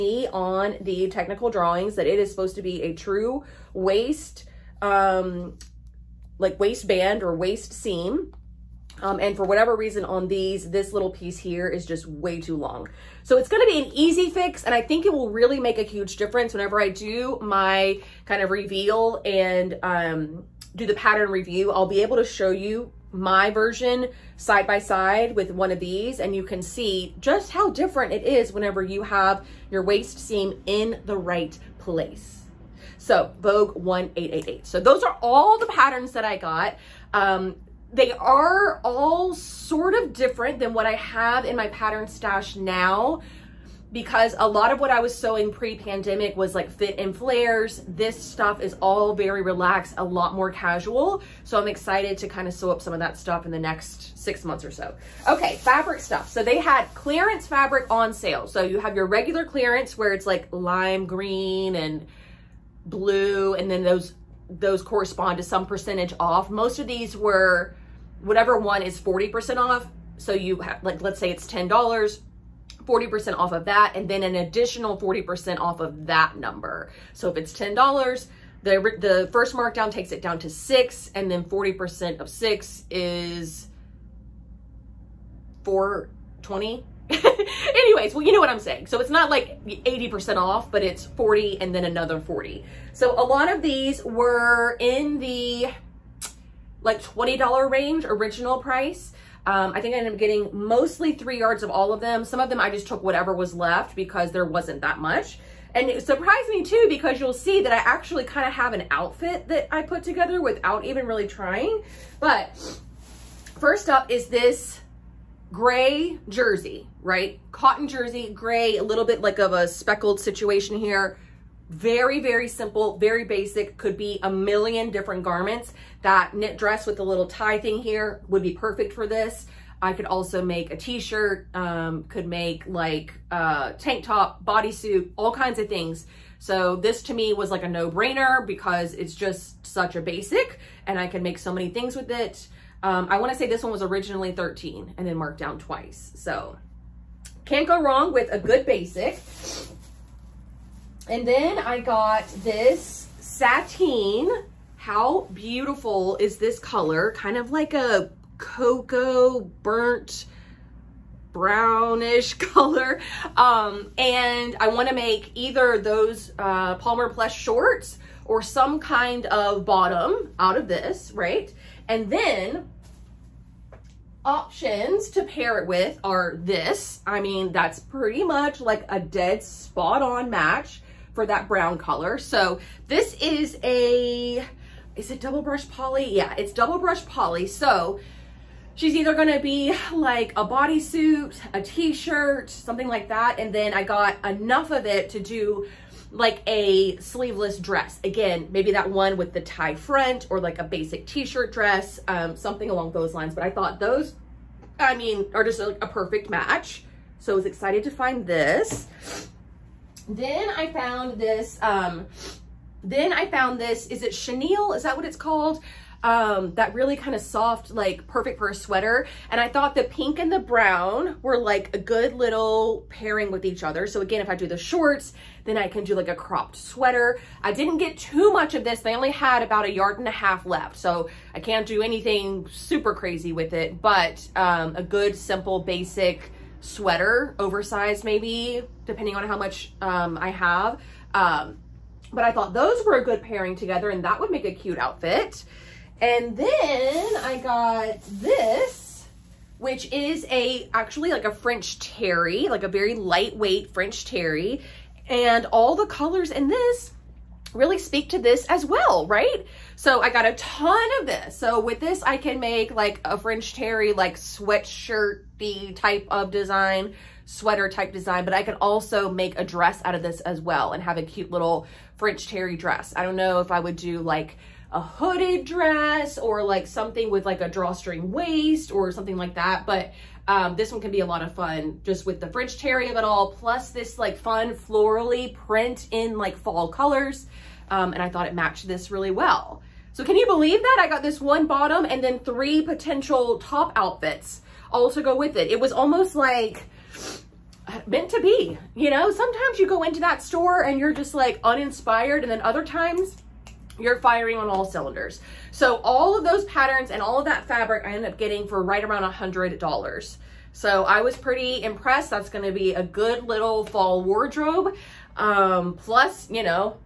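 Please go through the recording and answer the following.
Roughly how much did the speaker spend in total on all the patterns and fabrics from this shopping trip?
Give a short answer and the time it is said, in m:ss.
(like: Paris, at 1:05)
$100, at 5:09.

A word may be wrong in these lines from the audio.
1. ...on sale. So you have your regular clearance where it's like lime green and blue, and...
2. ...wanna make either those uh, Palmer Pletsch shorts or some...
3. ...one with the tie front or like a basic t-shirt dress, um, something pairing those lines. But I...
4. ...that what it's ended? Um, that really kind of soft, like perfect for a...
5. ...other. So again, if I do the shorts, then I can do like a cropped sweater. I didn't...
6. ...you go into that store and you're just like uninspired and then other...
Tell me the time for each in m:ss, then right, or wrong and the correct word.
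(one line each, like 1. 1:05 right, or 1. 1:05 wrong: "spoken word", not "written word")
1. 0:57 right
2. 2:44 right
3. 3:18 wrong: "along", not "pairing"
4. 3:34 wrong: "called", not "ended"
5. 3:43 right
6. 4:59 right.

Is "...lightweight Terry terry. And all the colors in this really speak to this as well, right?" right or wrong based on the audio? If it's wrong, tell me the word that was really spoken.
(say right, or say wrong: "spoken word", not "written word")
wrong: "French", not "Terry".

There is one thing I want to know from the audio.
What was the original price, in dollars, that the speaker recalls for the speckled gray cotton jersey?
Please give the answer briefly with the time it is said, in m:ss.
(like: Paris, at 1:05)
13, at 2:24.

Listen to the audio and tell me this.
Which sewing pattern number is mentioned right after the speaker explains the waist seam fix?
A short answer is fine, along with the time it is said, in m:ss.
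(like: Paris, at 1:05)
Vogue 1888, at 0:33.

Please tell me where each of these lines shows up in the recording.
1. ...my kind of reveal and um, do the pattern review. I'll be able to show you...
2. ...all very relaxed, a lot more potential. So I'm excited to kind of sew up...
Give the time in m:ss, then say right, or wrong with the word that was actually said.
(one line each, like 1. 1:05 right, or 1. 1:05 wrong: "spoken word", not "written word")
1. 0:17 right
2. 0:48 wrong: "casual", not "potential".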